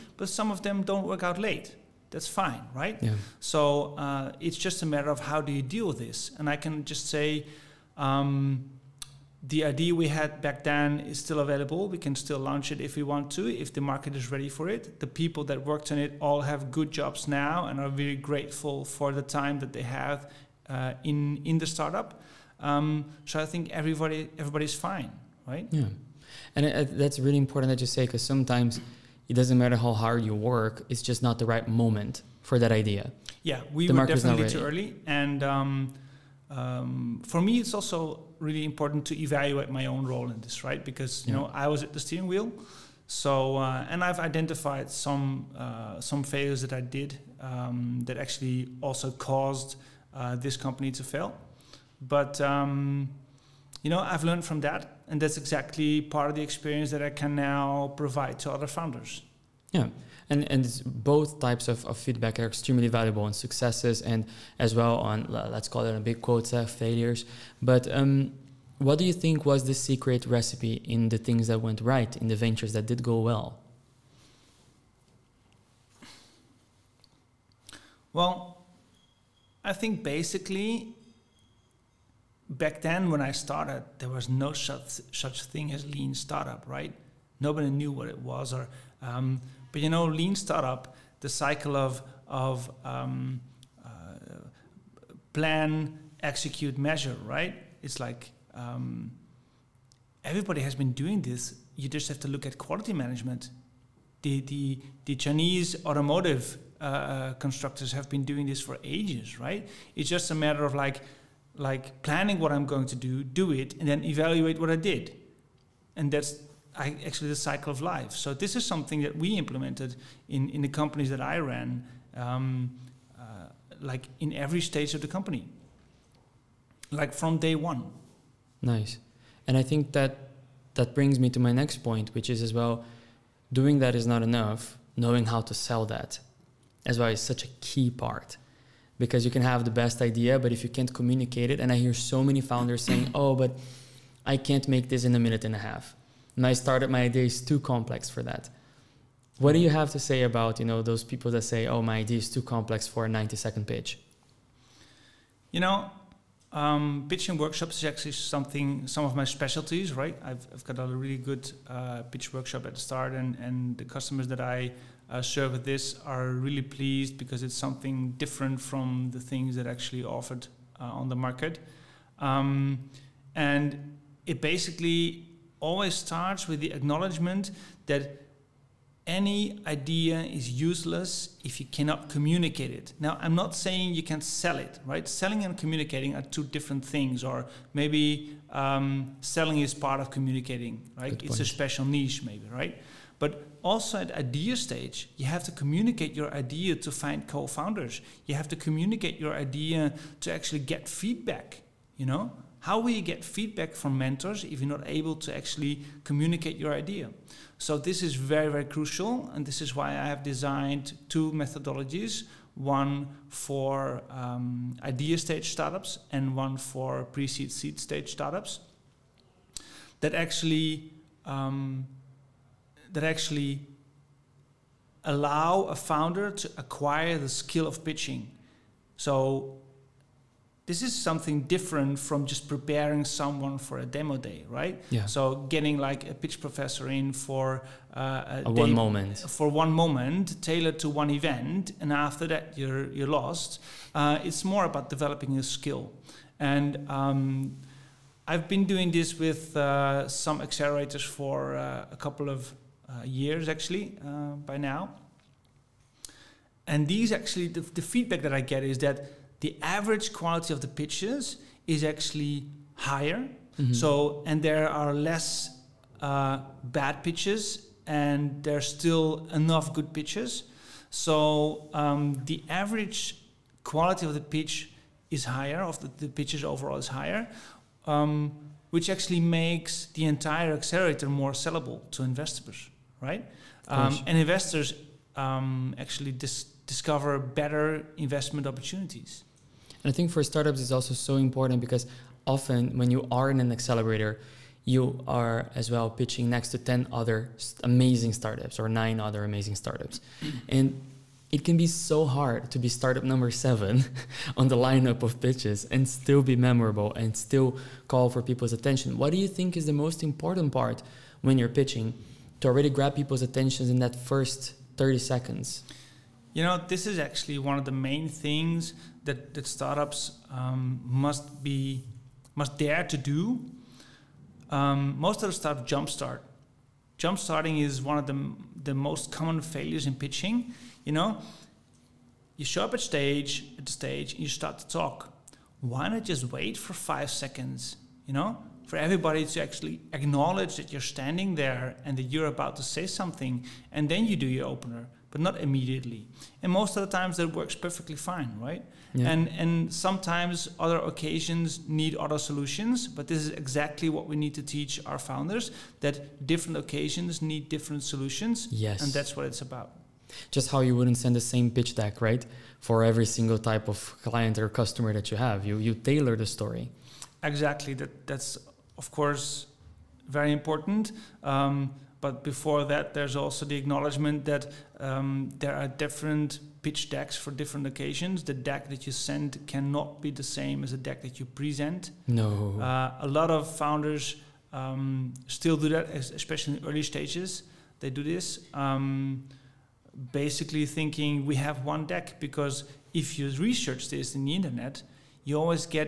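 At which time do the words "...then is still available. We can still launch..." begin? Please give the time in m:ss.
0:10.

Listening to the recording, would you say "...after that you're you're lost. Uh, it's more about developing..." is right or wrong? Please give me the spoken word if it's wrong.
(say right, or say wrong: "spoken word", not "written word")
right.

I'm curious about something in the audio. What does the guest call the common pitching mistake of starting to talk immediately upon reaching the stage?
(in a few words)
Jumpstarting.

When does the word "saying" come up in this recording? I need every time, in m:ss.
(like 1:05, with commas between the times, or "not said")
2:22, 3:03.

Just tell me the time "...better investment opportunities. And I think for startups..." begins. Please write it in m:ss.
4:47.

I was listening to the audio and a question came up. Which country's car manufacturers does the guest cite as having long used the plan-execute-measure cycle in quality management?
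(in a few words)
Chinese.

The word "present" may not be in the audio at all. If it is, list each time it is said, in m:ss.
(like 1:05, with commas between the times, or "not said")
6:21.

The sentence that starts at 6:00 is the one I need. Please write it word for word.
Just how you wouldn't send the same pitch deck, right?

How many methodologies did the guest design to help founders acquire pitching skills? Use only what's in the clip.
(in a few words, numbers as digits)
2.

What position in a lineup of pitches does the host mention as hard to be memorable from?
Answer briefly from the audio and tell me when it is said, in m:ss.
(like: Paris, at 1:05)
Number 7, at 5:03.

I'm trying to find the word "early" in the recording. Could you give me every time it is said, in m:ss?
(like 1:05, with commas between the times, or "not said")
0:34, 6:26.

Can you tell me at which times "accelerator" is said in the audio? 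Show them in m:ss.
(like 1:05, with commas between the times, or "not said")
4:10, 4:40, 4:53.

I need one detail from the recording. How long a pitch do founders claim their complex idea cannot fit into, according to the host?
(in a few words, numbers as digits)
90 seconds.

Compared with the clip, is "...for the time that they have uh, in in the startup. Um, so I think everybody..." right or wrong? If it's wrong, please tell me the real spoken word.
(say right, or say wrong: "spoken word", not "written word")
right.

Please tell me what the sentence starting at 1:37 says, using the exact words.
It's like um, everybody has been doing this.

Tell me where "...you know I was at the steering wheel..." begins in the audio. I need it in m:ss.
0:41.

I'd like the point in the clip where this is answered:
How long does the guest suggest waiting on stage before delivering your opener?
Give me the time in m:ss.
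5:36.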